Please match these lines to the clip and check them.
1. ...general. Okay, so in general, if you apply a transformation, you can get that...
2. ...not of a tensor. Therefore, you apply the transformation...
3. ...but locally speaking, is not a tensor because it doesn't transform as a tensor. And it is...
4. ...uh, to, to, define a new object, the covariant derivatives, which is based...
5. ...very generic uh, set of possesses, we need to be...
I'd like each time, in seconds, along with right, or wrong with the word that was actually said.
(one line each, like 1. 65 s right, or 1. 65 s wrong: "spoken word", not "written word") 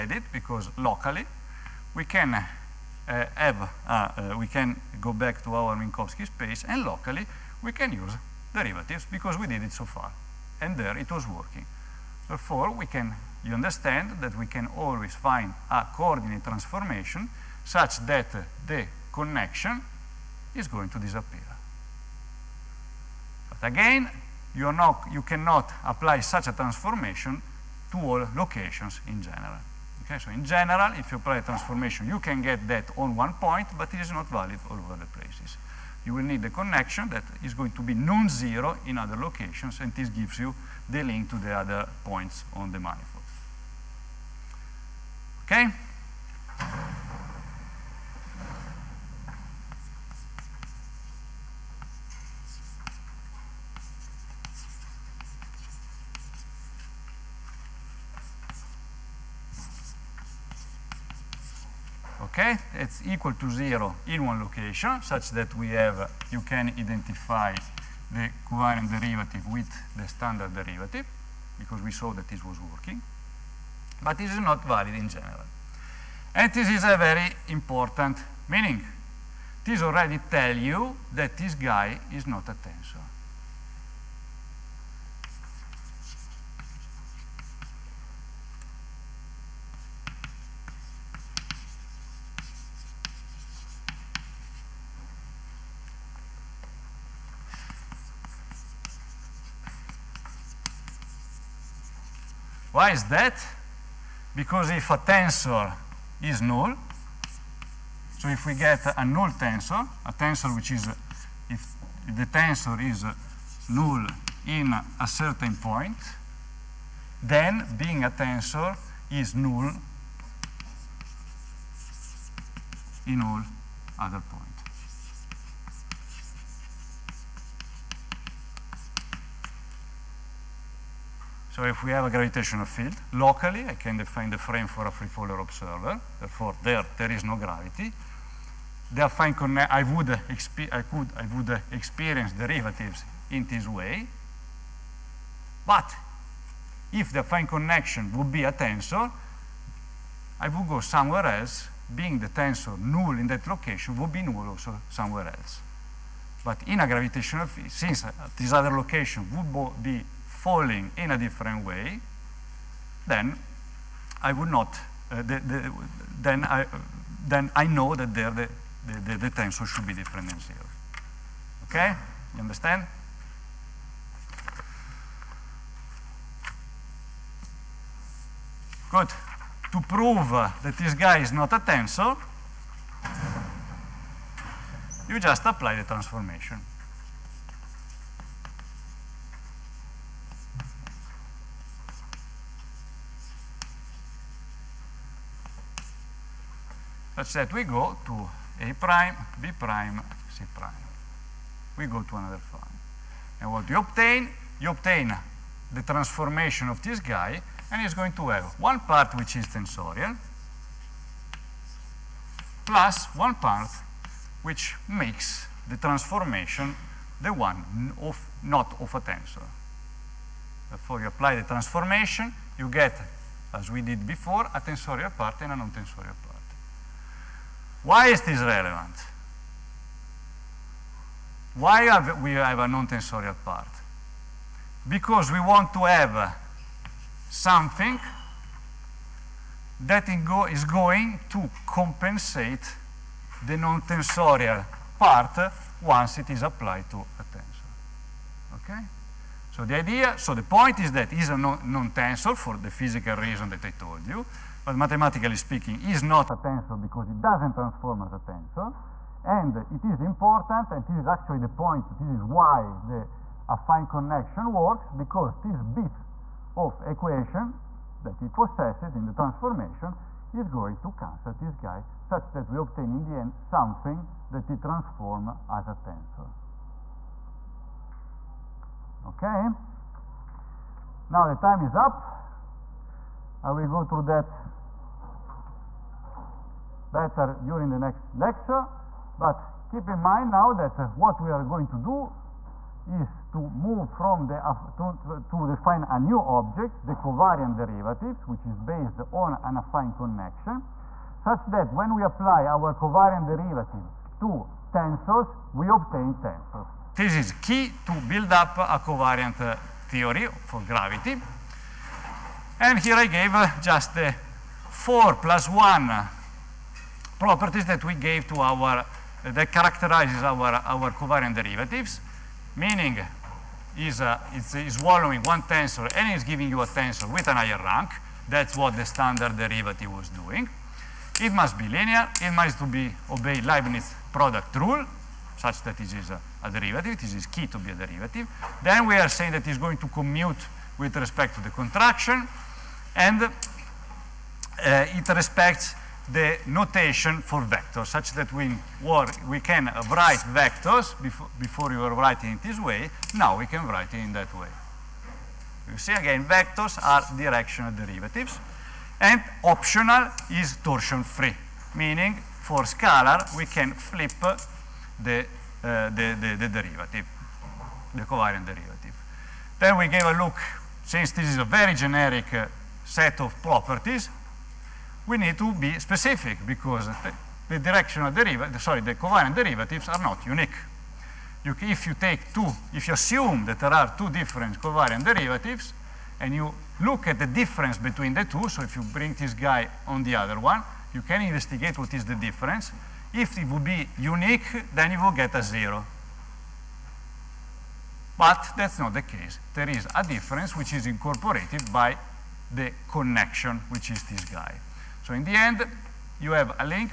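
1. 29 s right
2. 218 s right
3. 254 s wrong: "mathematically", not "locally"
4. 294 s right
5. 371 s wrong: "properties", not "possesses".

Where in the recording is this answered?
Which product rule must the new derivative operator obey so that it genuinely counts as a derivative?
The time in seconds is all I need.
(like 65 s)
333 s.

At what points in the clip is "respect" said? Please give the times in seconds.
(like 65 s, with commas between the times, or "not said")
340 s, 345 s.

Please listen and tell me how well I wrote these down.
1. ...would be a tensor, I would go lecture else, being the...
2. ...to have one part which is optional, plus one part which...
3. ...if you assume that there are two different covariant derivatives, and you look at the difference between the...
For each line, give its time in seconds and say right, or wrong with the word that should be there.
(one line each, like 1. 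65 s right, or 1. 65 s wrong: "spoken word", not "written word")
1. 148 s wrong: "somewhere", not "lecture"
2. 208 s wrong: "tensorial", not "optional"
3. 382 s right.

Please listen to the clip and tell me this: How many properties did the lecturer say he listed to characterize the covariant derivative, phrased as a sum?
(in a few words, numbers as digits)
4 plus 1.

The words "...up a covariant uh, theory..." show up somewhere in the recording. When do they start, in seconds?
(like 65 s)
308 s.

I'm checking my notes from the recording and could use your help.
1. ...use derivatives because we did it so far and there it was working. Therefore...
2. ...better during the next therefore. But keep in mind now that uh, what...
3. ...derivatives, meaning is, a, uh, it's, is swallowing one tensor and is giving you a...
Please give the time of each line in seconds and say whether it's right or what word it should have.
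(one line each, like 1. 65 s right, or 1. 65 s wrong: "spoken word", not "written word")
1. 7 s right
2. 286 s wrong: "lecture", not "therefore"
3. 321 s right.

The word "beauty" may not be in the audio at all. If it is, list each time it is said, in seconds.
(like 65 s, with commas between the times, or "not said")
not said.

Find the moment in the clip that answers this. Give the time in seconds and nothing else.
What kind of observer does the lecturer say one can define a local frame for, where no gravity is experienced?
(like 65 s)
134 s.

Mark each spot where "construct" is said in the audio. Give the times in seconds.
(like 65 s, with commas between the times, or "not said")
not said.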